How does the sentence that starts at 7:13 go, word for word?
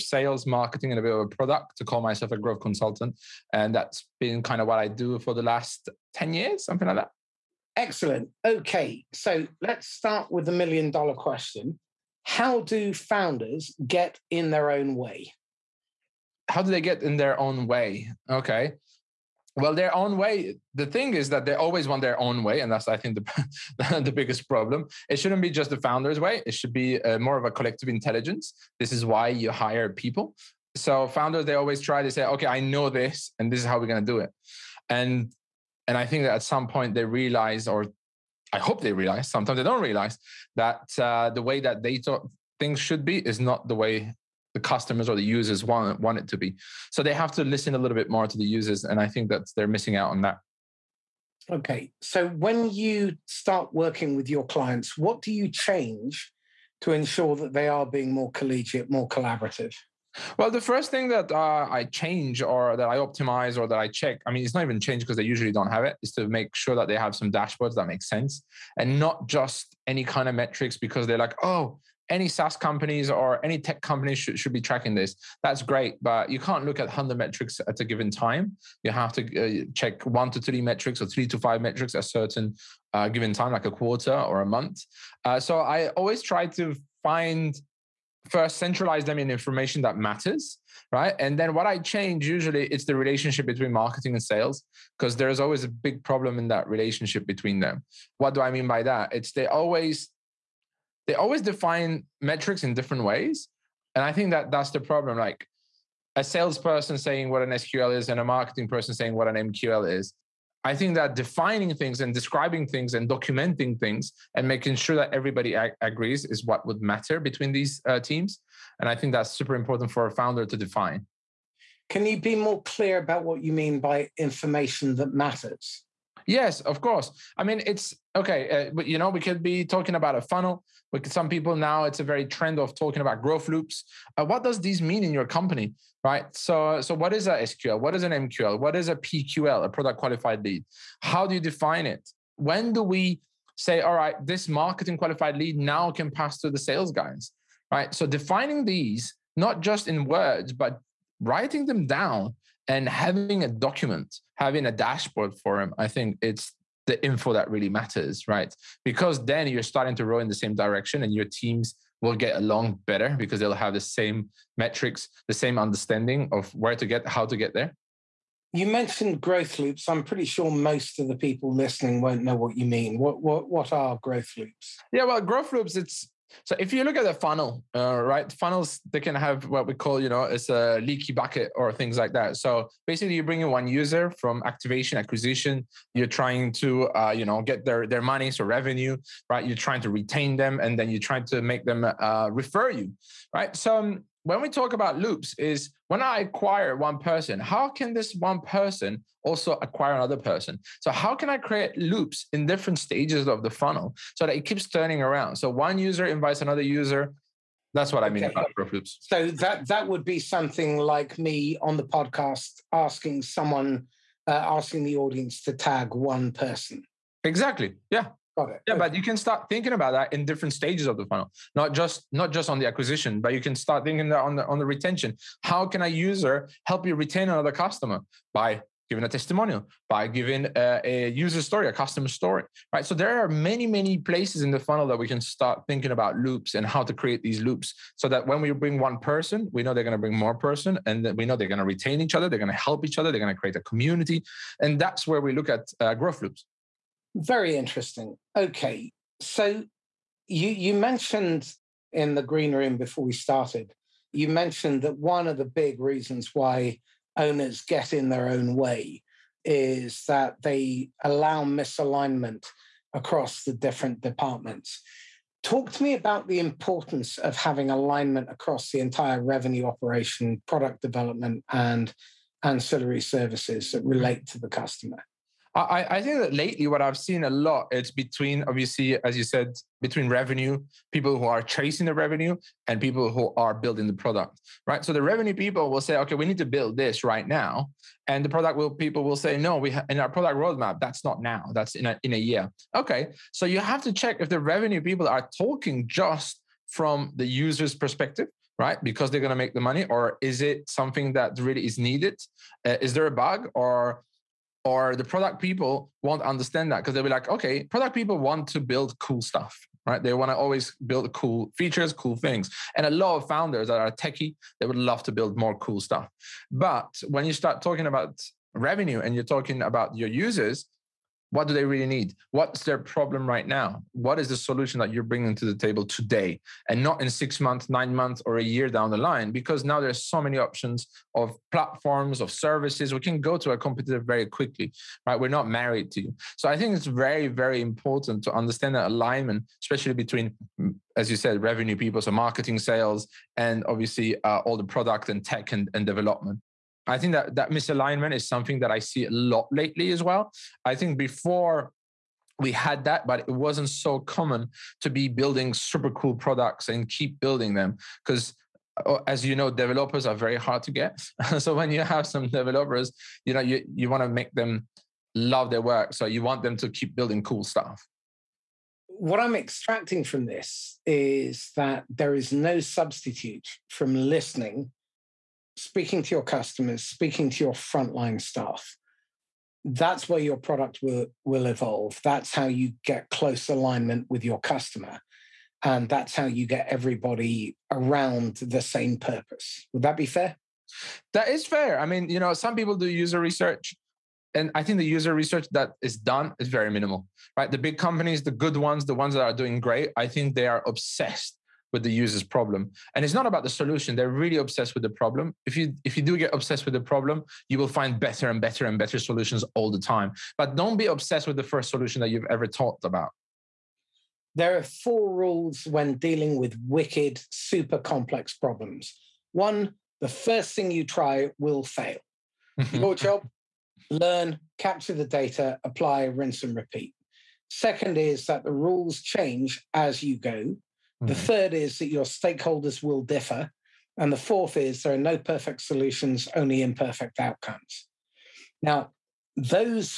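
And the fourth is there are no perfect solutions, only imperfect outcomes.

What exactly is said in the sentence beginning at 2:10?
With some people now it's a very trend of talking about growth loops.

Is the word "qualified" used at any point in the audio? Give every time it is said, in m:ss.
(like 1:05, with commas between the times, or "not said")
2:19, 2:24.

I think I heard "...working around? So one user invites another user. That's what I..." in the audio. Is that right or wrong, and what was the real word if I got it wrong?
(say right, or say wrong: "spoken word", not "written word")
wrong: "turning", not "working".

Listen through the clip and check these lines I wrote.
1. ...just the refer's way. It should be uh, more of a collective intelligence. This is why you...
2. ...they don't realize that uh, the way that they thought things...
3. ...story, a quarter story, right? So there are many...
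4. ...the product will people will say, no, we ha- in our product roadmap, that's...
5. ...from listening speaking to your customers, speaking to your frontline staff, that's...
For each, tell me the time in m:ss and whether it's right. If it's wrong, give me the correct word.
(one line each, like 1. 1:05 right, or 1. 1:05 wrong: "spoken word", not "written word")
1. 0:25 wrong: "founder", not "refer"
2. 0:39 right
3. 3:51 wrong: "customer", not "quarter"
4. 4:48 right
5. 6:13 right.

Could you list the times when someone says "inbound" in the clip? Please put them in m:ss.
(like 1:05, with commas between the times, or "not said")
not said.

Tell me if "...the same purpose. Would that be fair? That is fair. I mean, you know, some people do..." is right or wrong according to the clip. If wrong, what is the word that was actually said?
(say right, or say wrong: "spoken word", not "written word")
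right.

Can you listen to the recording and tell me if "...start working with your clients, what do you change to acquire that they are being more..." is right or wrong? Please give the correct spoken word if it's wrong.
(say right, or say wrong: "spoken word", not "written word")
wrong: "ensure", not "acquire".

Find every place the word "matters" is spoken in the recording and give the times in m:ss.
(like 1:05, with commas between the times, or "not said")
1:29, 1:56, 2:05, 2:37.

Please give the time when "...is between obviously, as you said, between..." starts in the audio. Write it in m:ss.
4:37.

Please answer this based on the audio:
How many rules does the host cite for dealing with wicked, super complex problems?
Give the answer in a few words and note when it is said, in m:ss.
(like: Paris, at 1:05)
4, at 6:54.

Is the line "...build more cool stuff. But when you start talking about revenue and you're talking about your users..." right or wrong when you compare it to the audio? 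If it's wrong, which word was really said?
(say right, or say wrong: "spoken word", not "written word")
right.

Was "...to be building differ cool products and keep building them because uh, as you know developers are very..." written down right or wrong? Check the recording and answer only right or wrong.
wrong.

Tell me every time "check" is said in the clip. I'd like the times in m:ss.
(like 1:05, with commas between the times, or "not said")
1:03, 1:19, 4:53.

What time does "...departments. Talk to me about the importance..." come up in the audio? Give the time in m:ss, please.
4:24.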